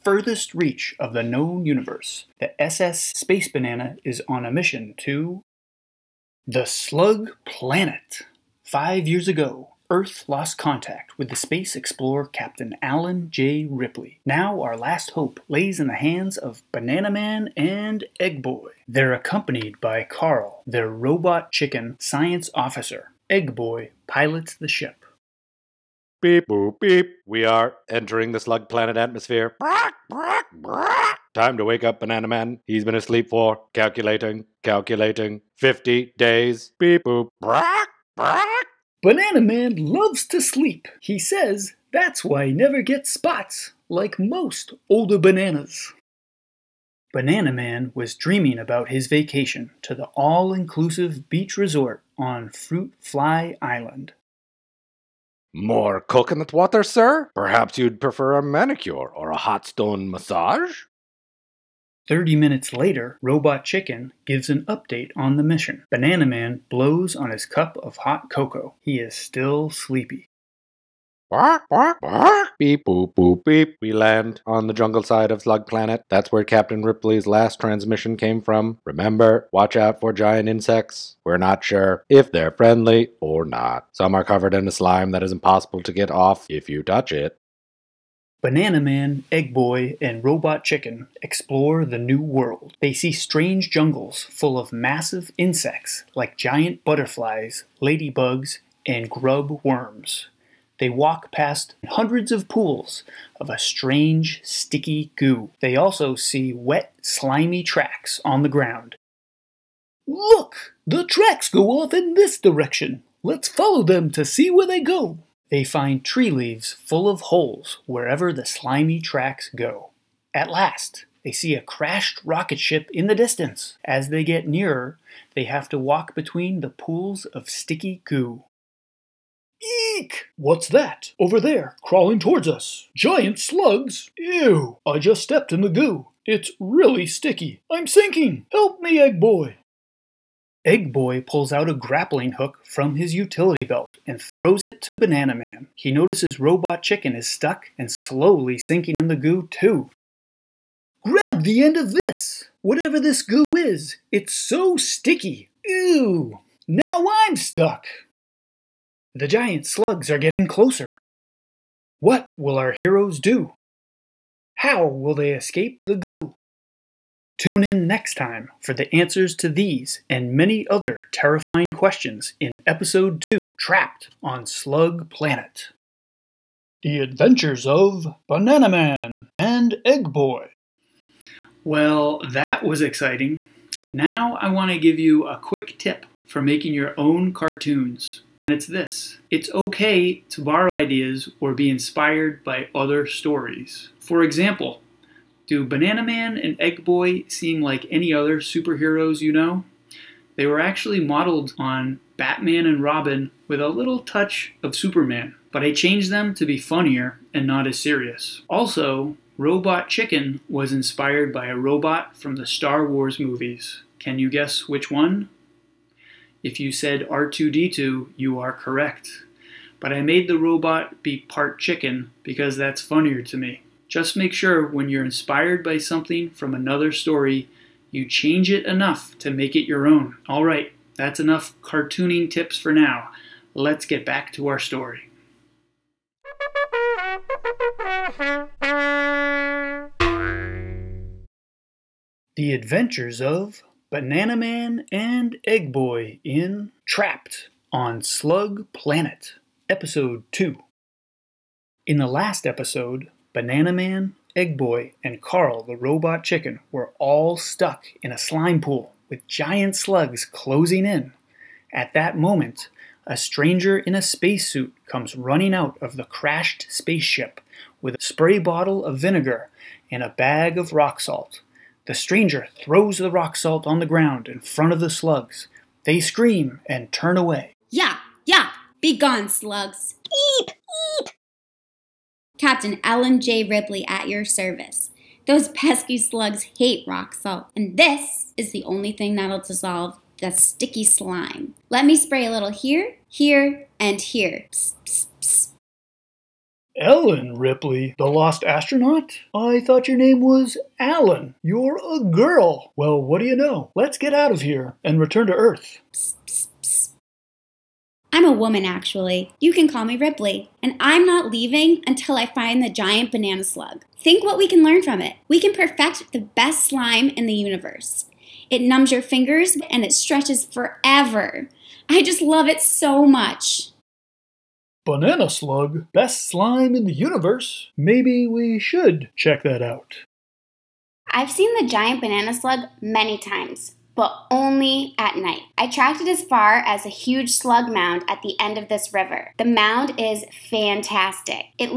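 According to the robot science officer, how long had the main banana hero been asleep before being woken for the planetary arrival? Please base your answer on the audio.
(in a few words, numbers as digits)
50 days.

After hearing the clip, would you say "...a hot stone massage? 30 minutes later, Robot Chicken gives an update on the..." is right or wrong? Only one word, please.
right.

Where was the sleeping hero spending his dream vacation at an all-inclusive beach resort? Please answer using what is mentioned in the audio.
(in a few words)
Fruit Fly Island.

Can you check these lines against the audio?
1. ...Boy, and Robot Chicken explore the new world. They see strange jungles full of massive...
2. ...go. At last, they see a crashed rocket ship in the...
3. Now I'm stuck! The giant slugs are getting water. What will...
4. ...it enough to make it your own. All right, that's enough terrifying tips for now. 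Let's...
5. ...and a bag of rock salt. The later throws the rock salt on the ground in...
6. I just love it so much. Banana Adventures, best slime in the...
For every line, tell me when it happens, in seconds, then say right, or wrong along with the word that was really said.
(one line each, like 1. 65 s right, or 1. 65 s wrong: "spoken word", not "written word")
1. 89 s right
2. 119 s right
3. 156 s wrong: "closer", not "water"
4. 228 s wrong: "cartooning", not "terrifying"
5. 269 s wrong: "stranger", not "later"
6. 321 s wrong: "Slug", not "Adventures".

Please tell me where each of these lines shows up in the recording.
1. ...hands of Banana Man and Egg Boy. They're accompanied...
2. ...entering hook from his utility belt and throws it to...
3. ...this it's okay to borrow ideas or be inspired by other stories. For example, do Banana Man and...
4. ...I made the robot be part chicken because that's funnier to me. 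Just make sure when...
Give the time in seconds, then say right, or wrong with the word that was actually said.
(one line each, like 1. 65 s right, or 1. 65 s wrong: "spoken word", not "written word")
1. 15 s right
2. 141 s wrong: "grappling", not "entering"
3. 188 s right
4. 219 s right.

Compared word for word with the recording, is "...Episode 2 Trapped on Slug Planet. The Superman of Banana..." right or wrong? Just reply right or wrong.
wrong.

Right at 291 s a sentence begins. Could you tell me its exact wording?
Let me spray a little here, here, and here.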